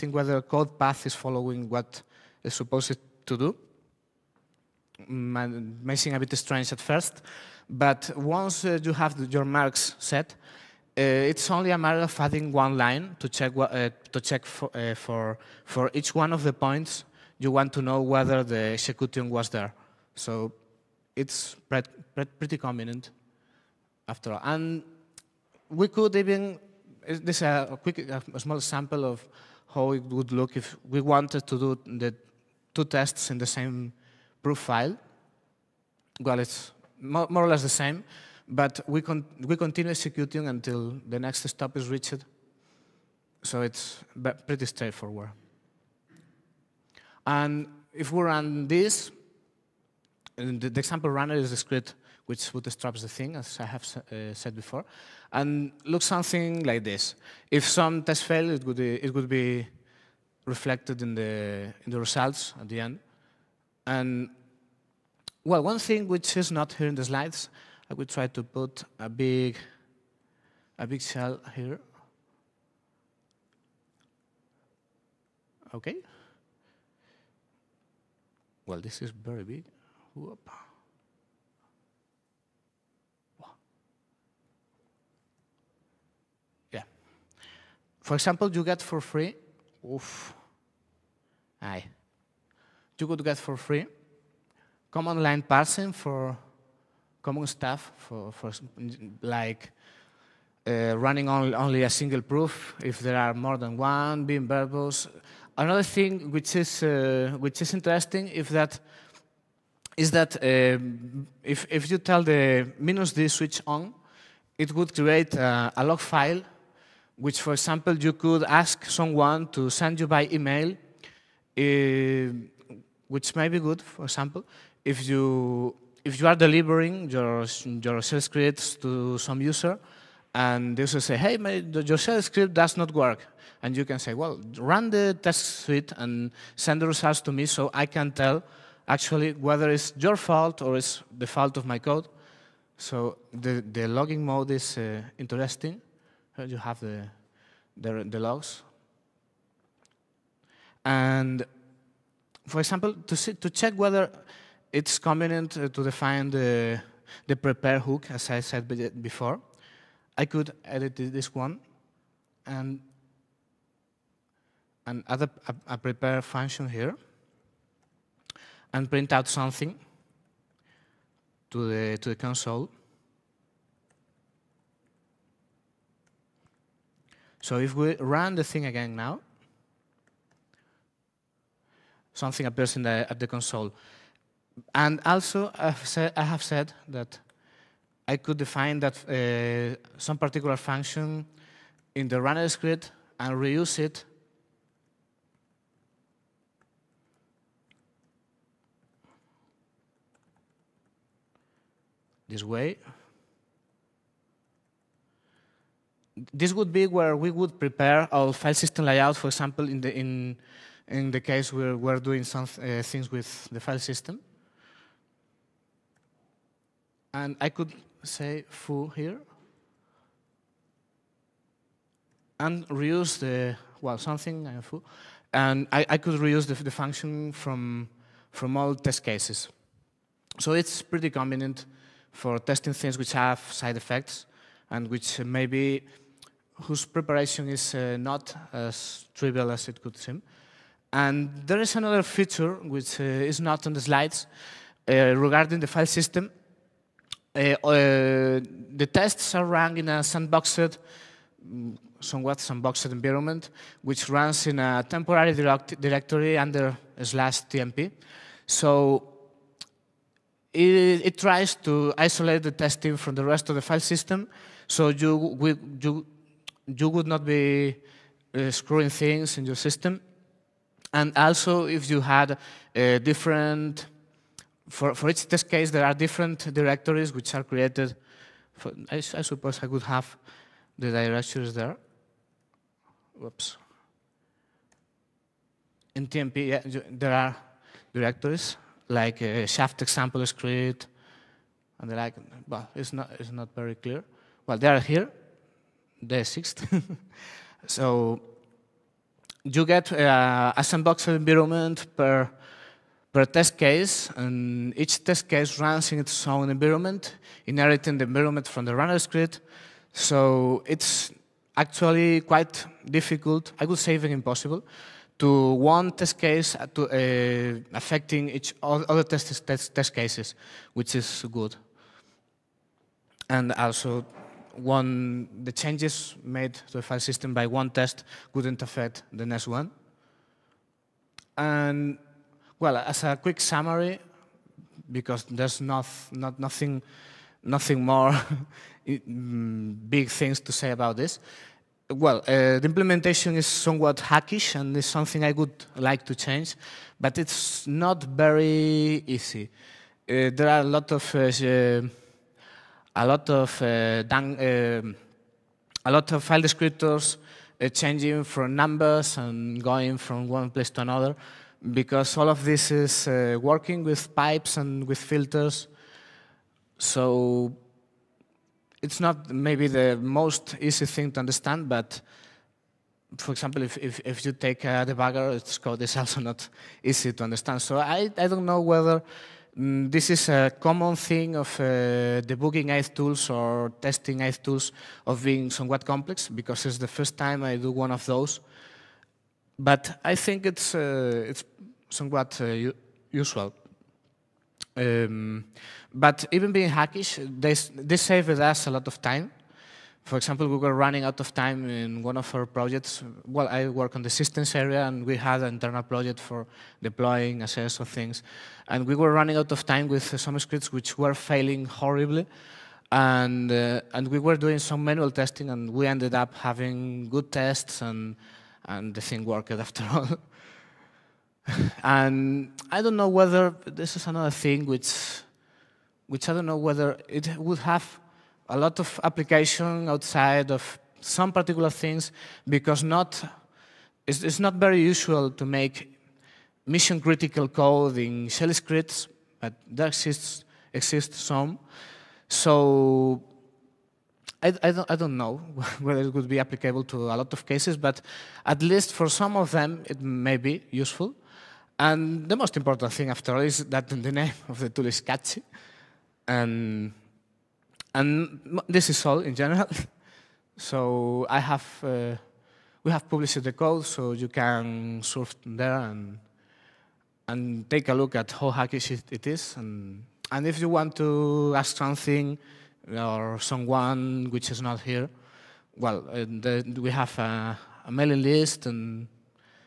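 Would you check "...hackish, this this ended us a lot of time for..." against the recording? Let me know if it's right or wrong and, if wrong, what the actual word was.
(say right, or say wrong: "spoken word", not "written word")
wrong: "saved", not "ended".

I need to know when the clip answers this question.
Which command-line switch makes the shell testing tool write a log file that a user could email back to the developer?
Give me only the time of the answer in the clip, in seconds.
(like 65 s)
112 s.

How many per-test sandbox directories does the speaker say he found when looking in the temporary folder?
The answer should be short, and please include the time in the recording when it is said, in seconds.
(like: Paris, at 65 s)
6, at 296 s.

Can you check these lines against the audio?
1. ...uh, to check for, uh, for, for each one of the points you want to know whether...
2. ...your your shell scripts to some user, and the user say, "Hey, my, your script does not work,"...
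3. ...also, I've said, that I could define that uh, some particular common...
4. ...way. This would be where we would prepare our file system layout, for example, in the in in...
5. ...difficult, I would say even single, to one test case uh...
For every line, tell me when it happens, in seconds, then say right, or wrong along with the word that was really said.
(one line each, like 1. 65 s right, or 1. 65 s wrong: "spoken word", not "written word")
1. 13 s right
2. 127 s right
3. 185 s wrong: "function", not "common"
4. 202 s right
5. 312 s wrong: "impossible", not "single".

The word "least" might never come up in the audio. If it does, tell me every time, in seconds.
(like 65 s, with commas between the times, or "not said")
448 s.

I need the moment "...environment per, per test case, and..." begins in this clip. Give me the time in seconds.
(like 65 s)
301 s.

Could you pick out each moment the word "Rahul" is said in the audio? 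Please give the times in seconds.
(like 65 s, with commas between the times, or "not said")
not said.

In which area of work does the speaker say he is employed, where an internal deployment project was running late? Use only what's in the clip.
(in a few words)
systems.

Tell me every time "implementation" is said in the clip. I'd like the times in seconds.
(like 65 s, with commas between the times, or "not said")
342 s.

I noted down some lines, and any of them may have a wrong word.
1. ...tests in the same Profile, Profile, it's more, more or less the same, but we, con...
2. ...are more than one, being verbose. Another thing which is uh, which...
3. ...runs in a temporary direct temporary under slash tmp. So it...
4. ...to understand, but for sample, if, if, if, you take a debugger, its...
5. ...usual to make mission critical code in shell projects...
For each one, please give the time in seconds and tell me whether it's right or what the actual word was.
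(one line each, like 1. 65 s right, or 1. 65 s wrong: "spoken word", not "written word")
1. 32 s wrong: "Well", not "Profile"
2. 103 s right
3. 254 s wrong: "directory", not "temporary"
4. 371 s wrong: "example", not "sample"
5. 434 s wrong: "scripts", not "projects".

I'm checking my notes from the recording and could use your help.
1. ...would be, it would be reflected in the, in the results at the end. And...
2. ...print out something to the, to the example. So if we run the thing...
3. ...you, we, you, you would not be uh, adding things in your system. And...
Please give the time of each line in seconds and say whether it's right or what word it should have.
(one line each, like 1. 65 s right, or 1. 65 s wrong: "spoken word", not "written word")
1. 58 s right
2. 168 s wrong: "console", not "example"
3. 264 s wrong: "screwing", not "adding".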